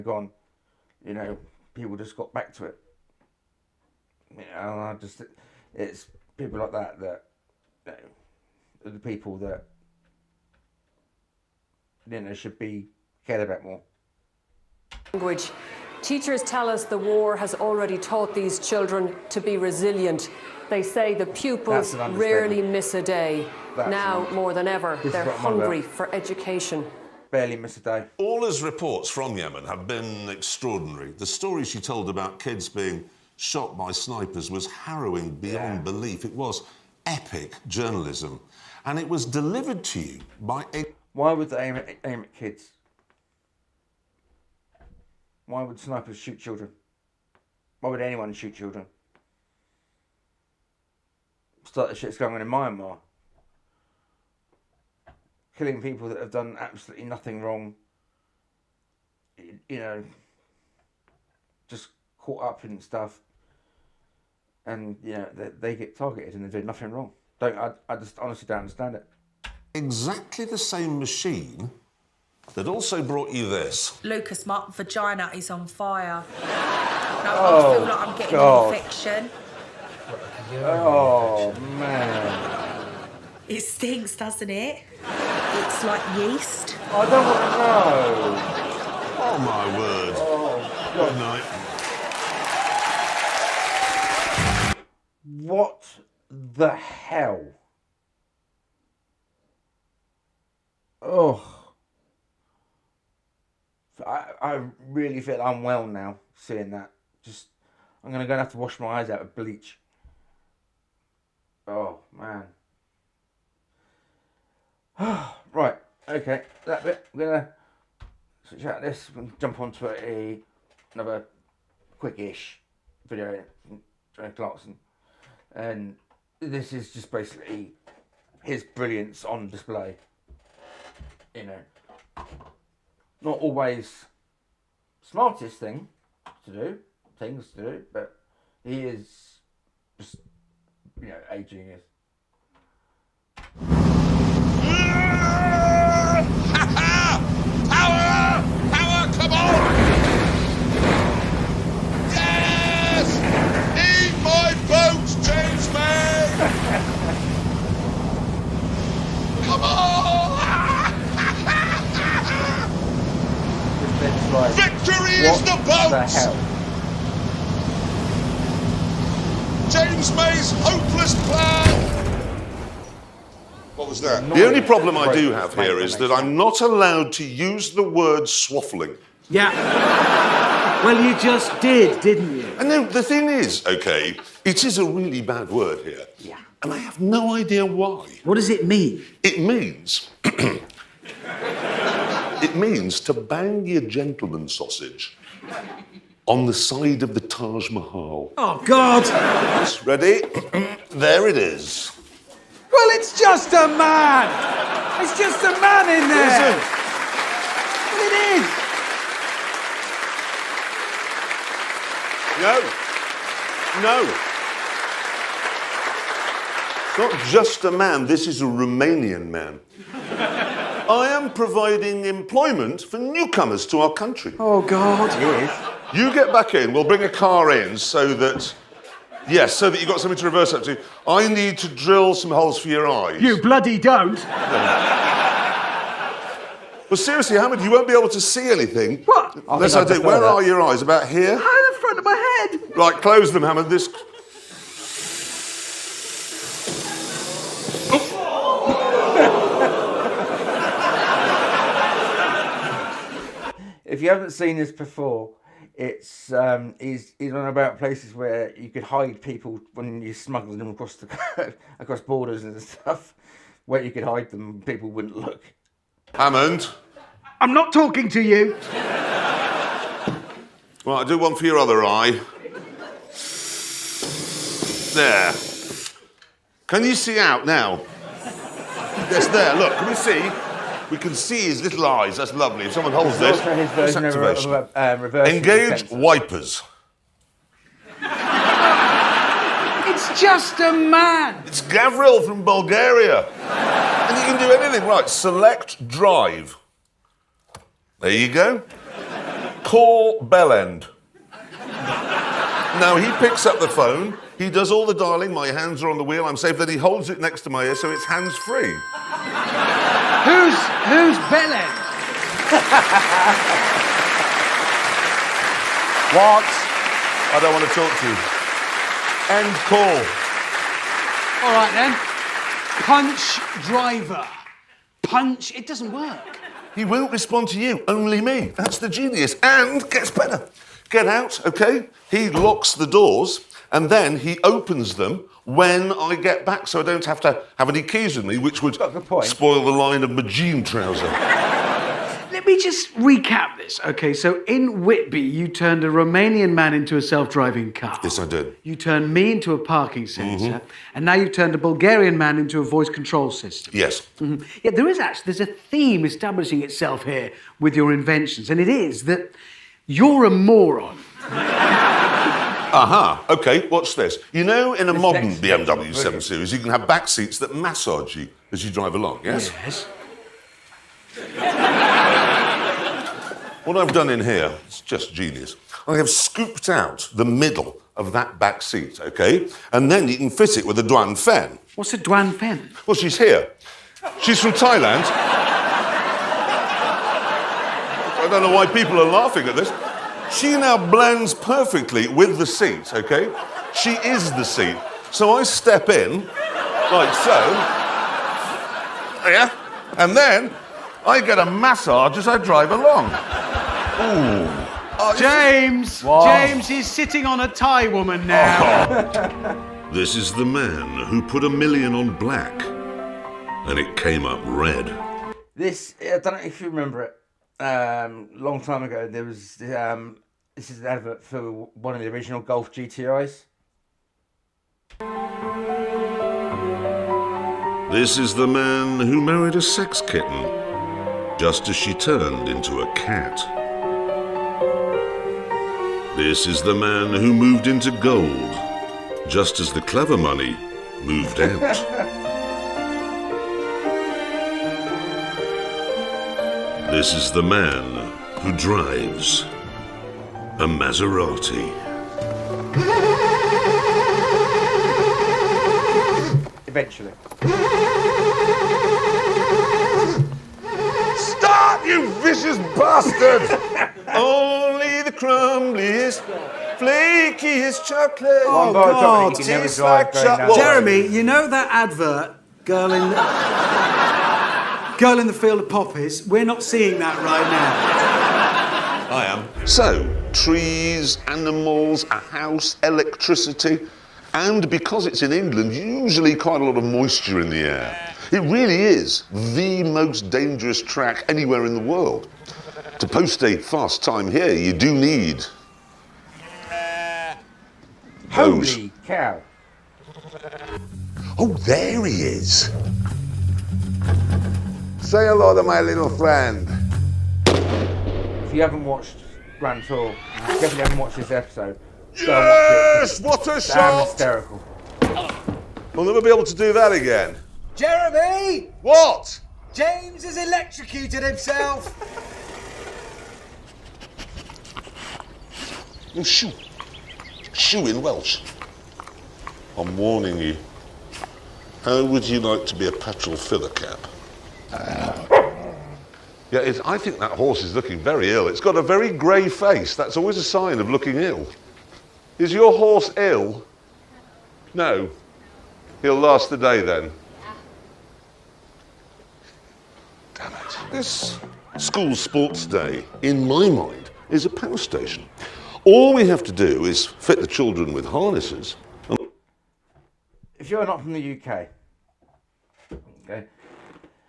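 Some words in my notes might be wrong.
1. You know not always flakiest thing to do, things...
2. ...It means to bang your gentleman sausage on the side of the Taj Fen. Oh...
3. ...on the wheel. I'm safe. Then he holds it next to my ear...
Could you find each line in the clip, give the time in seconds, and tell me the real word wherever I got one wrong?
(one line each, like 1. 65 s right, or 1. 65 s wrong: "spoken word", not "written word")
1. 131 s wrong: "smartest", not "flakiest"
2. 192 s wrong: "Mahal", not "Fen"
3. 305 s right.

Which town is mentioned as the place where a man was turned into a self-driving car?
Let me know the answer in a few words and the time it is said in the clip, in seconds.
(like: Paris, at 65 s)
Whitby, at 344 s.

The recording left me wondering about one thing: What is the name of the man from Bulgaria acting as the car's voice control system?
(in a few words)
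Gavril.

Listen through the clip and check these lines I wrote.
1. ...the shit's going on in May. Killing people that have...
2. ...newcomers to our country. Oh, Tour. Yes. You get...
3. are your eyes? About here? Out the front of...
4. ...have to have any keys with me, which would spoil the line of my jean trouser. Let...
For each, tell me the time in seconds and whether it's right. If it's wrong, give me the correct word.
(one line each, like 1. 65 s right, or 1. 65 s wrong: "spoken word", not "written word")
1. 51 s wrong: "Myanmar", not "May"
2. 222 s wrong: "God", not "Tour"
3. 240 s right
4. 337 s right.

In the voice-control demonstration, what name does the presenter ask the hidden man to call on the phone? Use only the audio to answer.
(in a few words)
Bellend.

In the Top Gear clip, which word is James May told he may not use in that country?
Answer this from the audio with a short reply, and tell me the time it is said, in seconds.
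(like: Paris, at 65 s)
swaffling, at 178 s.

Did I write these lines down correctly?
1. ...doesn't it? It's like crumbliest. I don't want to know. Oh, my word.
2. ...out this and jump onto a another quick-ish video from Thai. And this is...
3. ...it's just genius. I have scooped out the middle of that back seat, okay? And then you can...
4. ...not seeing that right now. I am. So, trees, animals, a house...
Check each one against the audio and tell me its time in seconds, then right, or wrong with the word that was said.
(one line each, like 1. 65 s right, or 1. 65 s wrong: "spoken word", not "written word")
1. 84 s wrong: "yeast", not "crumbliest"
2. 118 s wrong: "Clarkson", not "Thai"
3. 374 s right
4. 476 s right.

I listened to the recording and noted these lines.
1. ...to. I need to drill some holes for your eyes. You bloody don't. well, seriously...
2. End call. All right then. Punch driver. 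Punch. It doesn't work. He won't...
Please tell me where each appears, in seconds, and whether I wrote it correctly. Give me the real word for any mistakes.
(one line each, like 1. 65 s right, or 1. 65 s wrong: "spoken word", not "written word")
1. 230 s right
2. 319 s right.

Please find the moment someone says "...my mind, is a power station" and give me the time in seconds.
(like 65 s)
553 s.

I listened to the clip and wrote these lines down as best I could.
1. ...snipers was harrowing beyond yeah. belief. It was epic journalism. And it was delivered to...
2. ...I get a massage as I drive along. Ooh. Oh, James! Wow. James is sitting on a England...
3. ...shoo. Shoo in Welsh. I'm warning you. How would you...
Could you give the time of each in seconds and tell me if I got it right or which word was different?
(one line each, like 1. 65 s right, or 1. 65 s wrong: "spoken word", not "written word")
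1. 33 s right
2. 401 s wrong: "Thai", not "England"
3. 526 s right.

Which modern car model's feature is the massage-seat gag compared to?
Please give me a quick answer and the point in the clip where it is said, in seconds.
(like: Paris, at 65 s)
BMW 7 Series, at 365 s.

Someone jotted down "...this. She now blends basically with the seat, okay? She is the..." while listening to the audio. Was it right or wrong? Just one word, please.
wrong.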